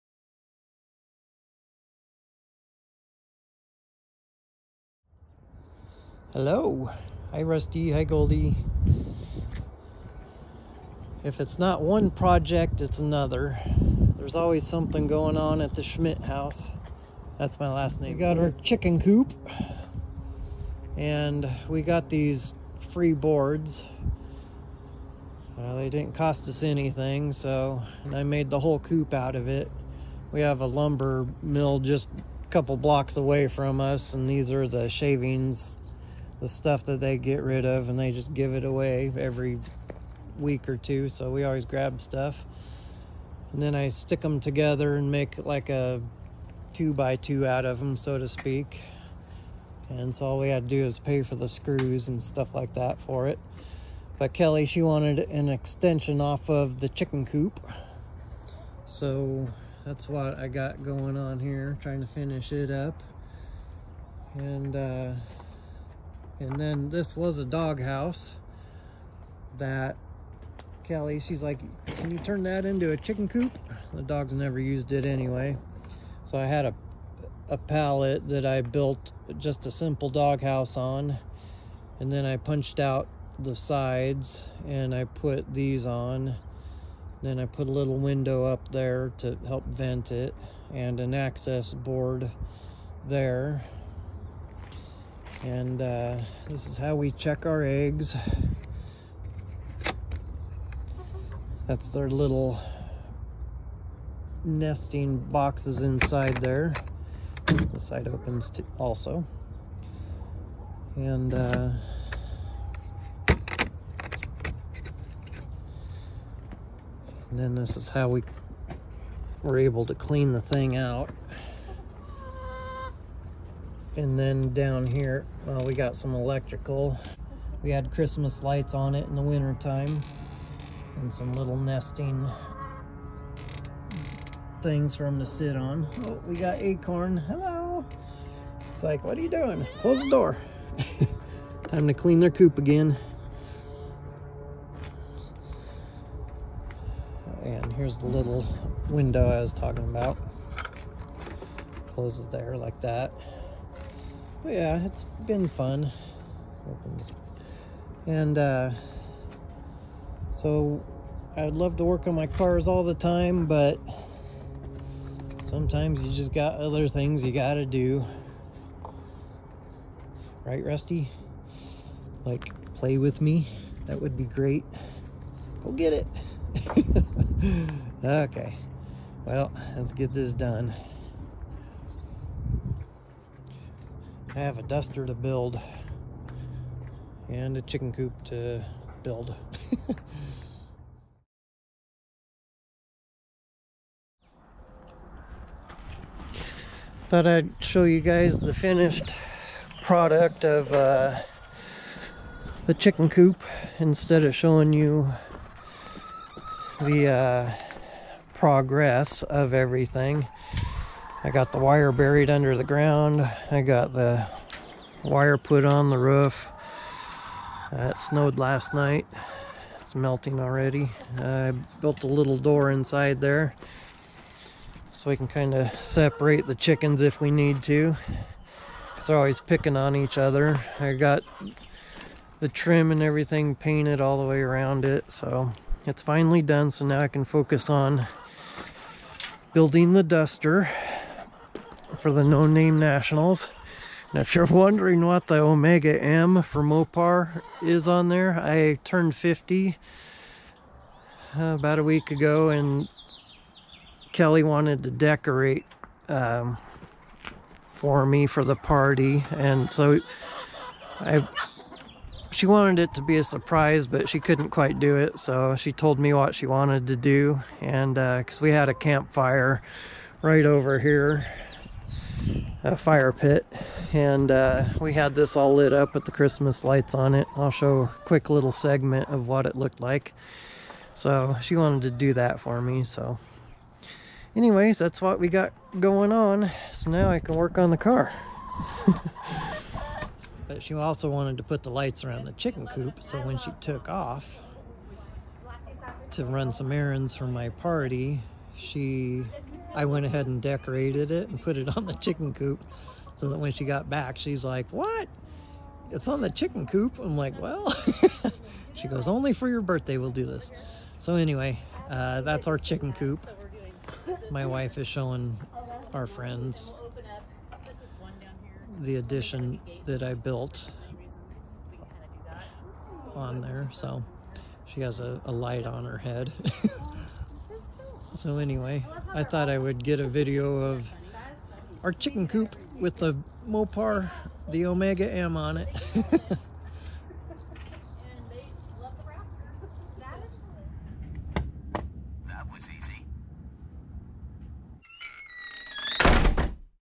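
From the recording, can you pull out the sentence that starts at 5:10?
So anyway, uh, that's our chicken coop.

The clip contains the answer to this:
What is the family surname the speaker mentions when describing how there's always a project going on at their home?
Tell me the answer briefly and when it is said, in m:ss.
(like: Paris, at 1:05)
Schmidt, at 0:15.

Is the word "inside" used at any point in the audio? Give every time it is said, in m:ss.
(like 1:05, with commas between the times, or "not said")
1:45, 3:42.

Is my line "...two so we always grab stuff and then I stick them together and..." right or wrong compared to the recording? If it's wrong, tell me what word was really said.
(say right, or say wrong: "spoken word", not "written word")
right.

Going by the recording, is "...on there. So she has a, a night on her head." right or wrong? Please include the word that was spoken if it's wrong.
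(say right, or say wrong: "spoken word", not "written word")
wrong: "light", not "night".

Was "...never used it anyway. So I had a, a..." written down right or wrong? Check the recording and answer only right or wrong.
right.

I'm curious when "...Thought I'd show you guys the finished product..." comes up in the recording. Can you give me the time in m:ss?
3:17.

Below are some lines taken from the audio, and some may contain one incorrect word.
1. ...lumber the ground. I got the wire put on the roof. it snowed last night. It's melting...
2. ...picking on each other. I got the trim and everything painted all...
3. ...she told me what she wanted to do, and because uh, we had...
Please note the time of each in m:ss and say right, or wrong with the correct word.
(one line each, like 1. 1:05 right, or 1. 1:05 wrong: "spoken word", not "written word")
1. 3:32 wrong: "under", not "lumber"
2. 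3:49 right
3. 4:25 right.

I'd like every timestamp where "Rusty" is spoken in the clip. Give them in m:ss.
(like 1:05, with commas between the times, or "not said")
0:07, 2:50.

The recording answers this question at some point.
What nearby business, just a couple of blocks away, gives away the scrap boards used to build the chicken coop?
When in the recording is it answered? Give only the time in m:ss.
0:30.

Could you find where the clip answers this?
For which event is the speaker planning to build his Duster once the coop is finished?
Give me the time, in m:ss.
4:02.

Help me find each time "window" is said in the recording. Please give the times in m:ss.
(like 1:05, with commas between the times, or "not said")
1:27, 2:28.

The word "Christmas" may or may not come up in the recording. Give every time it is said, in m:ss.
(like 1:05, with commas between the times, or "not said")
2:07, 4:36.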